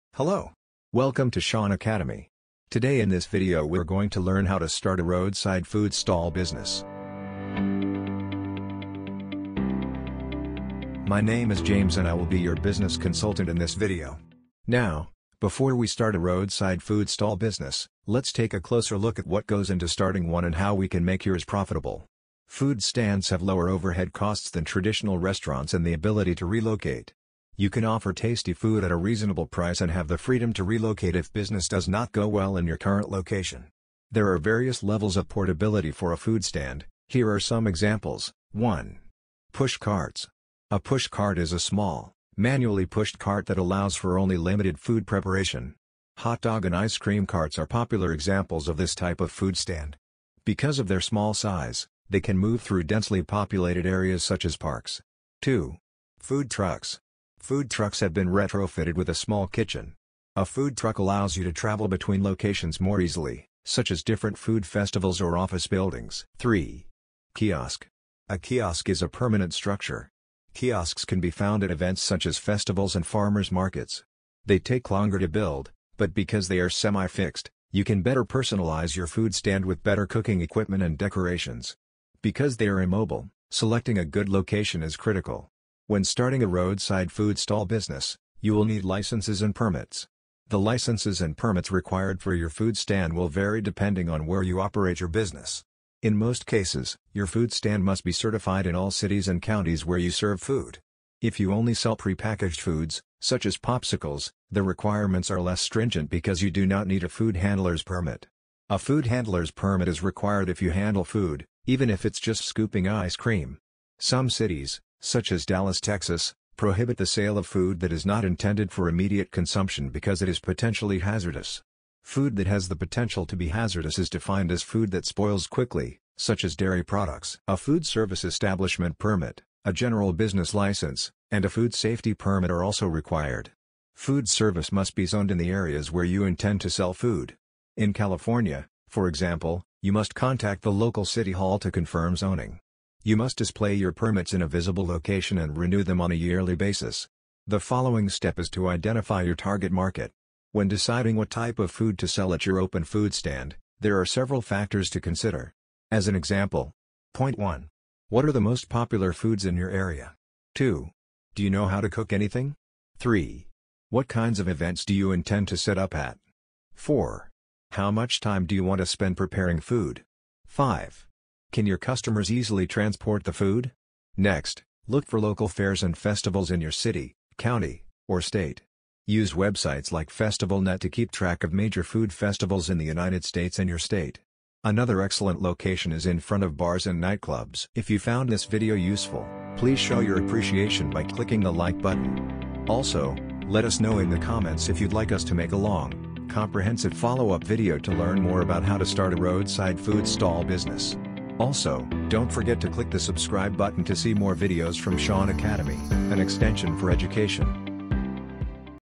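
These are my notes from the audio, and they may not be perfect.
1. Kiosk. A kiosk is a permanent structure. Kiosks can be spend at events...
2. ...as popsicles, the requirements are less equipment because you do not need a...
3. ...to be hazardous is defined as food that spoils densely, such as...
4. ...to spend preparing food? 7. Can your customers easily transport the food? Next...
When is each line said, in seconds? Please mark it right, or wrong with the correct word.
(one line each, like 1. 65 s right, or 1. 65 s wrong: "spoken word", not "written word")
1. 67 s wrong: "found", not "spend"
2. 103 s wrong: "stringent", not "equipment"
3. 123 s wrong: "quickly", not "densely"
4. 168 s wrong: "5", not "7".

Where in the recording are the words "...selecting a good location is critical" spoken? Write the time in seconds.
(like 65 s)
83 s.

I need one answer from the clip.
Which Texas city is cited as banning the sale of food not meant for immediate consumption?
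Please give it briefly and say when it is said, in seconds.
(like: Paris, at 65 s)
Dallas, at 115 s.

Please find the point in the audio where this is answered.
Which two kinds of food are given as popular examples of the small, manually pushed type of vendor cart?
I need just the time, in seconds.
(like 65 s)
46 s.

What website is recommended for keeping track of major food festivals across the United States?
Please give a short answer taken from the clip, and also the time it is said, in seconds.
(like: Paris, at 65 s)
FestivalNet, at 180 s.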